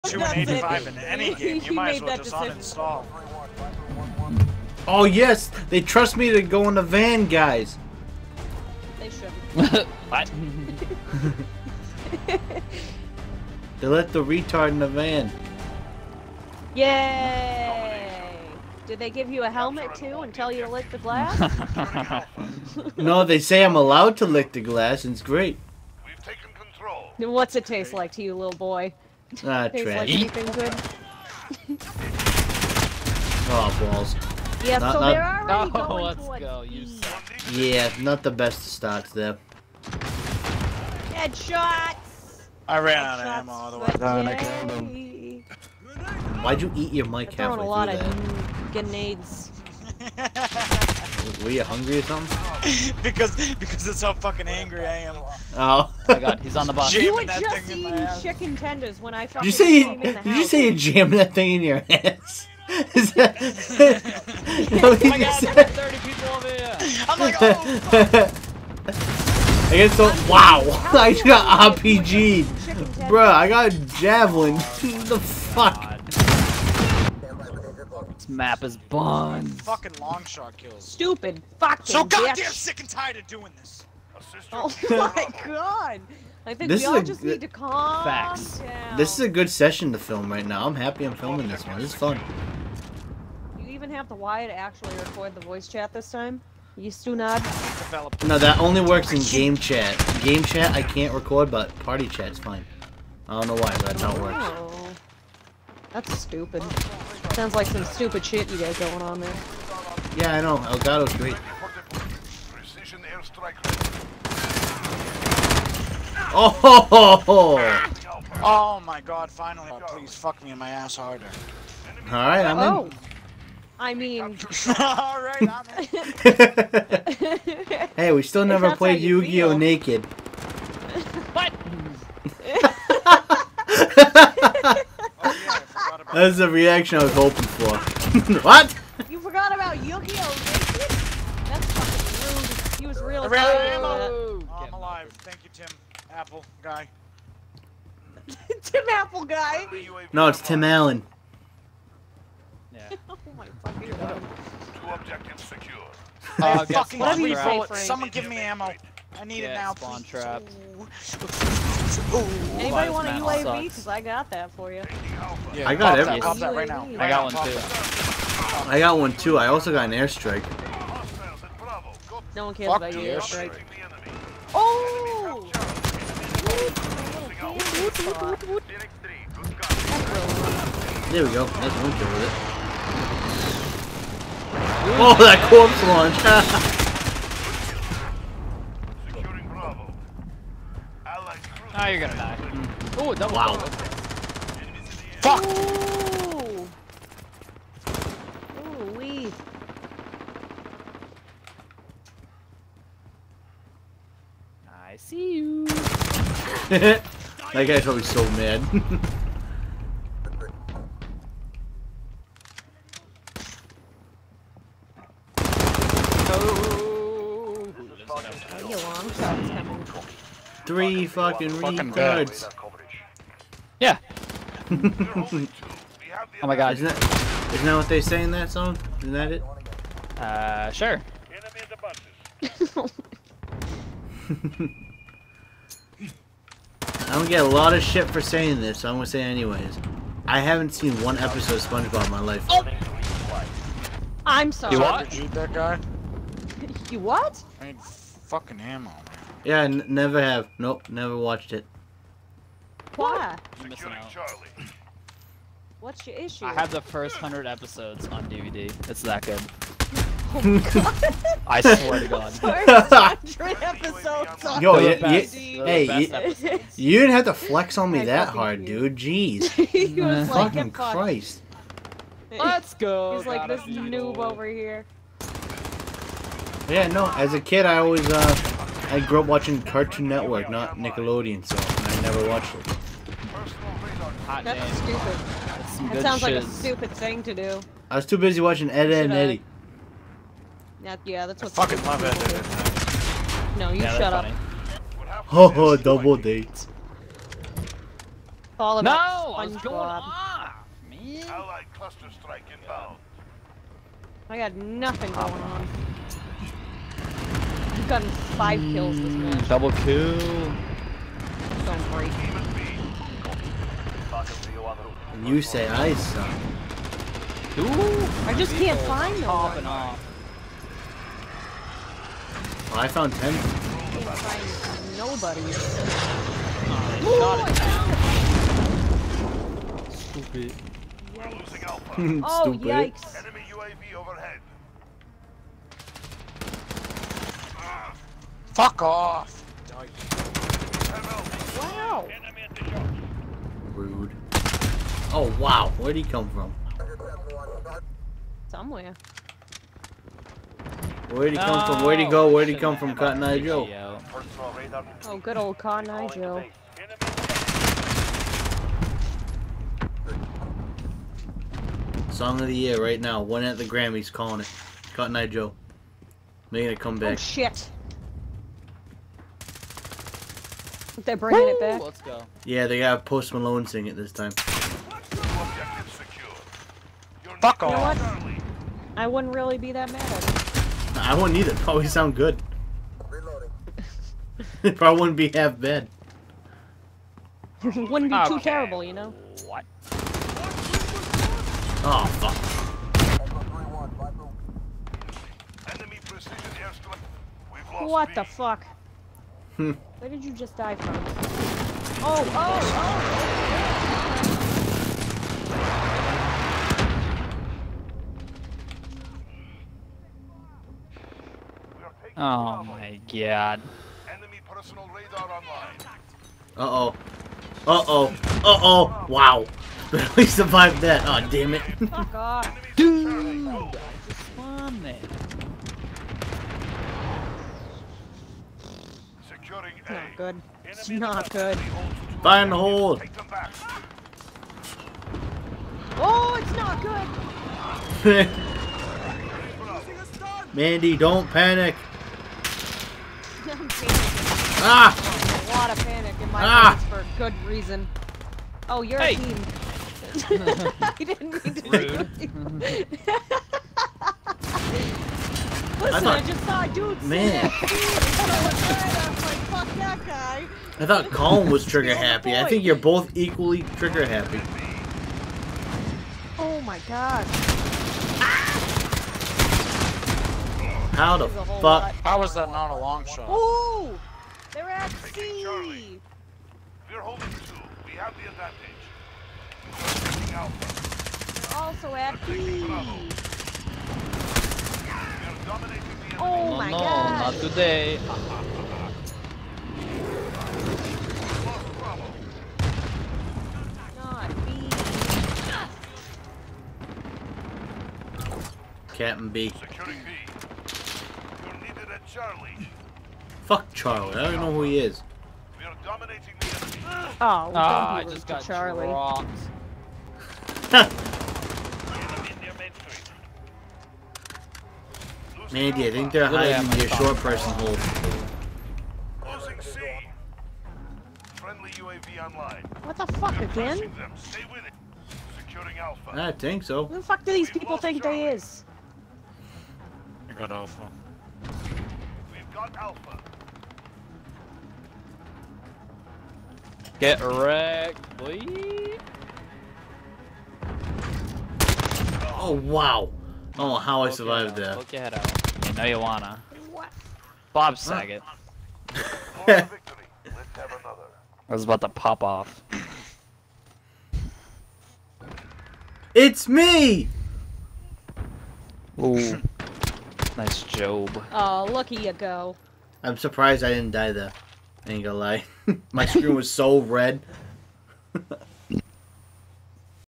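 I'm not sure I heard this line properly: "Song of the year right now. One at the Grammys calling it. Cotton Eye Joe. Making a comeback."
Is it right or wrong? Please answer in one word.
right.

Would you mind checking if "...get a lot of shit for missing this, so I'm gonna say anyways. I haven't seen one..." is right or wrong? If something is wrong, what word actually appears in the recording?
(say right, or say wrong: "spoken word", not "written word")
wrong: "saying", not "missing".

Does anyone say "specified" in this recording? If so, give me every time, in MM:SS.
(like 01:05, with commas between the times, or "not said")
not said.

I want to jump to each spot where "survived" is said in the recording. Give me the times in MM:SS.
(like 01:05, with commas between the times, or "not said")
07:00, 09:04.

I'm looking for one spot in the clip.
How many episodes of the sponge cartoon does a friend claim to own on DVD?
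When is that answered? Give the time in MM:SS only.
04:16.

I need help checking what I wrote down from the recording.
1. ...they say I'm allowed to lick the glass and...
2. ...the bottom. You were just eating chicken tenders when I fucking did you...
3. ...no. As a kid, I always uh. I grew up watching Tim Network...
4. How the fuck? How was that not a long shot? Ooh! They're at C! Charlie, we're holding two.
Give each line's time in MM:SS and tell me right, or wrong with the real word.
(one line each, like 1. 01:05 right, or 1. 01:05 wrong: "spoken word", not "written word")
1. 00:23 right
2. 00:56 right
3. 04:36 wrong: "Cartoon", not "Tim"
4. 07:50 right.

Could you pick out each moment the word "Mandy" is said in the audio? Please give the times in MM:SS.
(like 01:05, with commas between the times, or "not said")
07:20, 08:35.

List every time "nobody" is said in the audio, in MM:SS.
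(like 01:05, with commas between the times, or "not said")
05:24.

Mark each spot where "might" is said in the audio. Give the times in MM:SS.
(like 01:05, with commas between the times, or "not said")
00:01.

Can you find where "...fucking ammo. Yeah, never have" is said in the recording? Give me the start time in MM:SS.
04:07.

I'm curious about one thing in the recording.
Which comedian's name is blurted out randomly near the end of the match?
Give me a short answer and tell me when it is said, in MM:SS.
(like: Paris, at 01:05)
Bob Saget, at 09:07.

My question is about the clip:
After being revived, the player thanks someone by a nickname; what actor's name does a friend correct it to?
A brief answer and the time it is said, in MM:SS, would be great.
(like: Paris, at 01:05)
Tim Allen, at 02:30.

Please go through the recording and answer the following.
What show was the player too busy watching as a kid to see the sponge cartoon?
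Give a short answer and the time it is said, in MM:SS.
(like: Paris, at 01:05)
Ed, Edd n Eddy, at 04:48.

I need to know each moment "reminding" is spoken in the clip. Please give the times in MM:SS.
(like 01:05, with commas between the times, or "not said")
not said.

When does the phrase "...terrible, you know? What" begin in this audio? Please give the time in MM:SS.
06:28.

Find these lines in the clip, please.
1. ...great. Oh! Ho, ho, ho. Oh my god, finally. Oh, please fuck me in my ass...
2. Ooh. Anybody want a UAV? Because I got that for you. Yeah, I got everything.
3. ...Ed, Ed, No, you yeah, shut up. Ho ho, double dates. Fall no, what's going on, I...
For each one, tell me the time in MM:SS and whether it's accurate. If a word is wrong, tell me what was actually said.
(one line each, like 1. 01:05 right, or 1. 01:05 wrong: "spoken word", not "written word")
1. 01:51 right
2. 02:42 right
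3. 04:52 right.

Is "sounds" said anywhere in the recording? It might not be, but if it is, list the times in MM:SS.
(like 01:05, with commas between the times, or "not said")
01:47, 04:46, 06:21.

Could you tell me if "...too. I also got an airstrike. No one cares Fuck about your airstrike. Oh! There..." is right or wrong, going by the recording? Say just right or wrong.
right.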